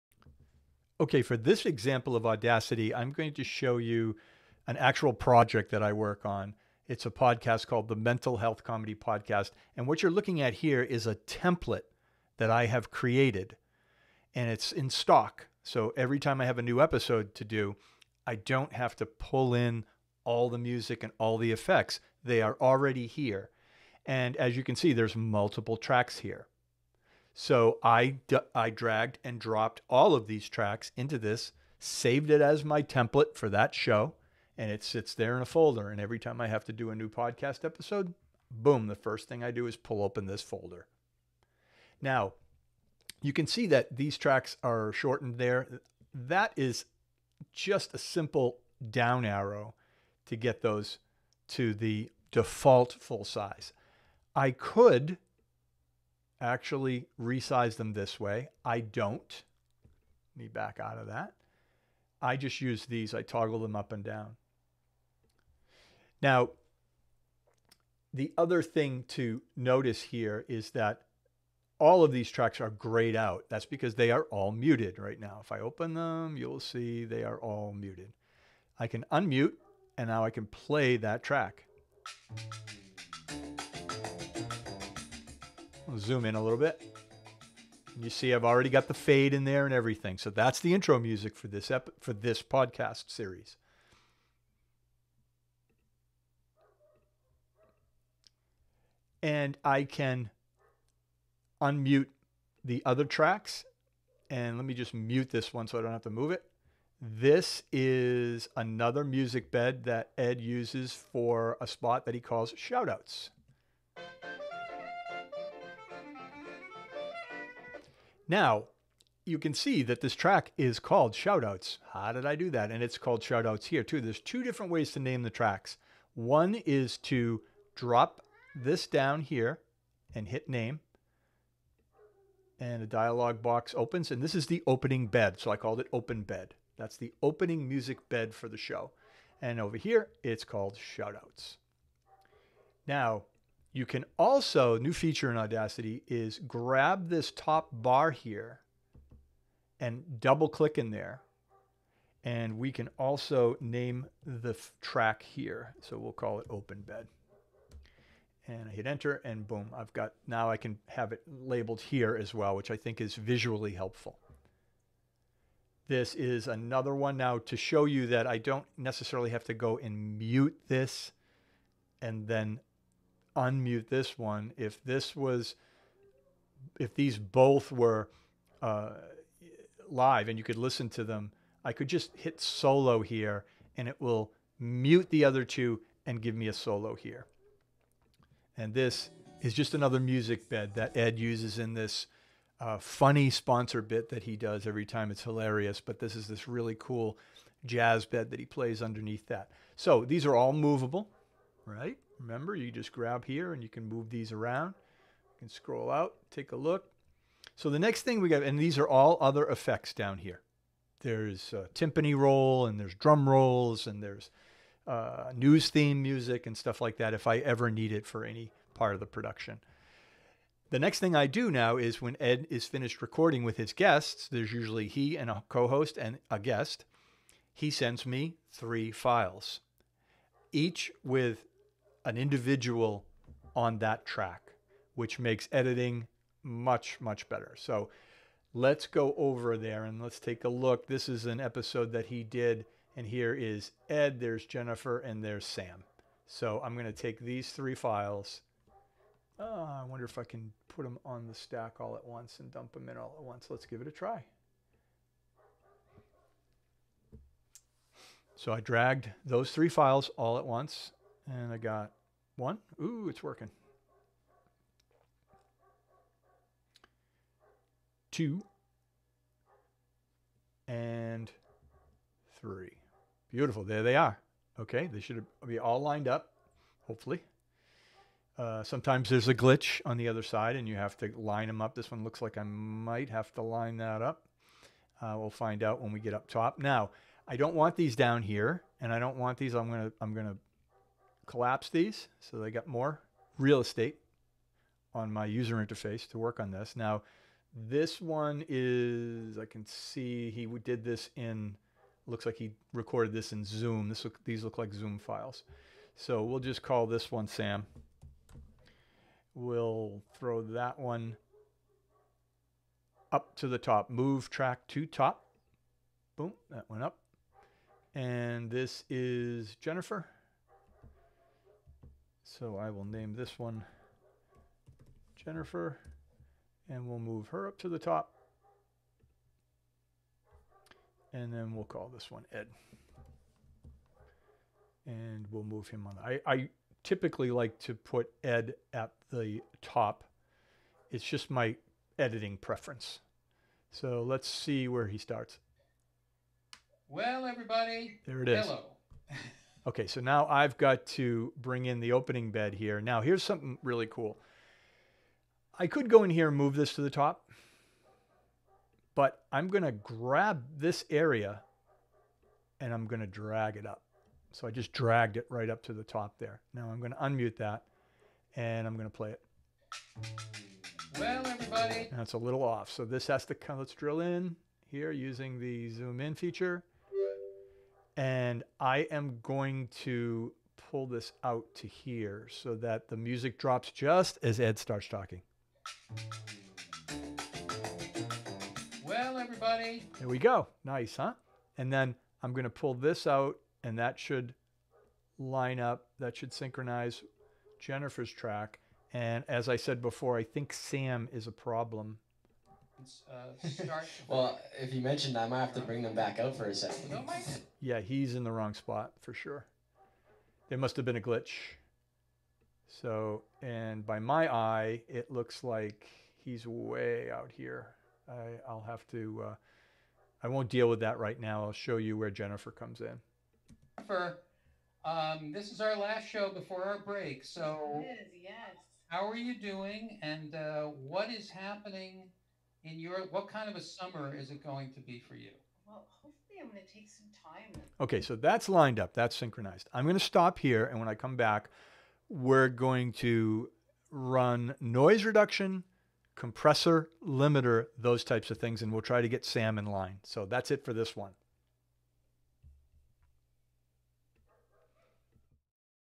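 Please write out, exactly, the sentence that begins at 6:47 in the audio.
yeah, he's in the wrong spot for sure.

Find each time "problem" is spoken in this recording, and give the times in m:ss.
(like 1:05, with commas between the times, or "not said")
6:41.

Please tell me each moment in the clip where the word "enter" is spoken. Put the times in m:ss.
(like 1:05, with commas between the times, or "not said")
2:38.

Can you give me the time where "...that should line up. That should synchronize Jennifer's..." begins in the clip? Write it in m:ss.
6:33.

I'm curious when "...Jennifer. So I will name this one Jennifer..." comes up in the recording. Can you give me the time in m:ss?
5:19.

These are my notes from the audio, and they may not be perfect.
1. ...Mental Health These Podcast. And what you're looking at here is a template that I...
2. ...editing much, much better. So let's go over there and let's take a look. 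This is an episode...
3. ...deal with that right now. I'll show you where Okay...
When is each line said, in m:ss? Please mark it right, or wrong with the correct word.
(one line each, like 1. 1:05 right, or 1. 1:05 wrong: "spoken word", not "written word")
1. 0:07 wrong: "Comedy", not "These"
2. 3:55 right
3. 7:00 wrong: "Jennifer", not "Okay".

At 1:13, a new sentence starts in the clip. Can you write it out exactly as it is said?
That's because they are all muted right now.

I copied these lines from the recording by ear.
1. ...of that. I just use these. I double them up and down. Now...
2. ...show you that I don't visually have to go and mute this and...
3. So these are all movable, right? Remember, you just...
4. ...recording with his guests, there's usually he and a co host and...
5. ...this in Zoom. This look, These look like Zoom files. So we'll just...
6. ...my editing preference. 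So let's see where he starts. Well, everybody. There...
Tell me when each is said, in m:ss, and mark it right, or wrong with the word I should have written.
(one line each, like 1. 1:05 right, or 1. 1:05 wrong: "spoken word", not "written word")
1. 1:00 wrong: "toggle", not "double"
2. 2:47 wrong: "necessarily", not "visually"
3. 3:19 right
4. 3:43 right
5. 5:03 right
6. 5:41 right.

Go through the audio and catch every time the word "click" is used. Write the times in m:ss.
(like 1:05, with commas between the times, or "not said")
2:30.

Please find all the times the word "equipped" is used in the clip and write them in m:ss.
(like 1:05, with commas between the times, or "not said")
not said.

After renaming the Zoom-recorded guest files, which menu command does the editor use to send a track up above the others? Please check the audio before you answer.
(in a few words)
Move track to top.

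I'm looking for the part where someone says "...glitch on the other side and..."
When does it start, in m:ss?
4:39.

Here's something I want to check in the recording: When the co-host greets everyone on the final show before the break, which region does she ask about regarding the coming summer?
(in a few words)
Europe.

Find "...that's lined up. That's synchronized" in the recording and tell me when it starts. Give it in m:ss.
7:18.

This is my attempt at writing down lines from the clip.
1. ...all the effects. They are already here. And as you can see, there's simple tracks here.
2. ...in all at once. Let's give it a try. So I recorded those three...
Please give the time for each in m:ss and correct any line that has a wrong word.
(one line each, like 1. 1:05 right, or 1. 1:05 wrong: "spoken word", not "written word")
1. 0:21 wrong: "multiple", not "simple"
2. 4:12 wrong: "dragged", not "recorded".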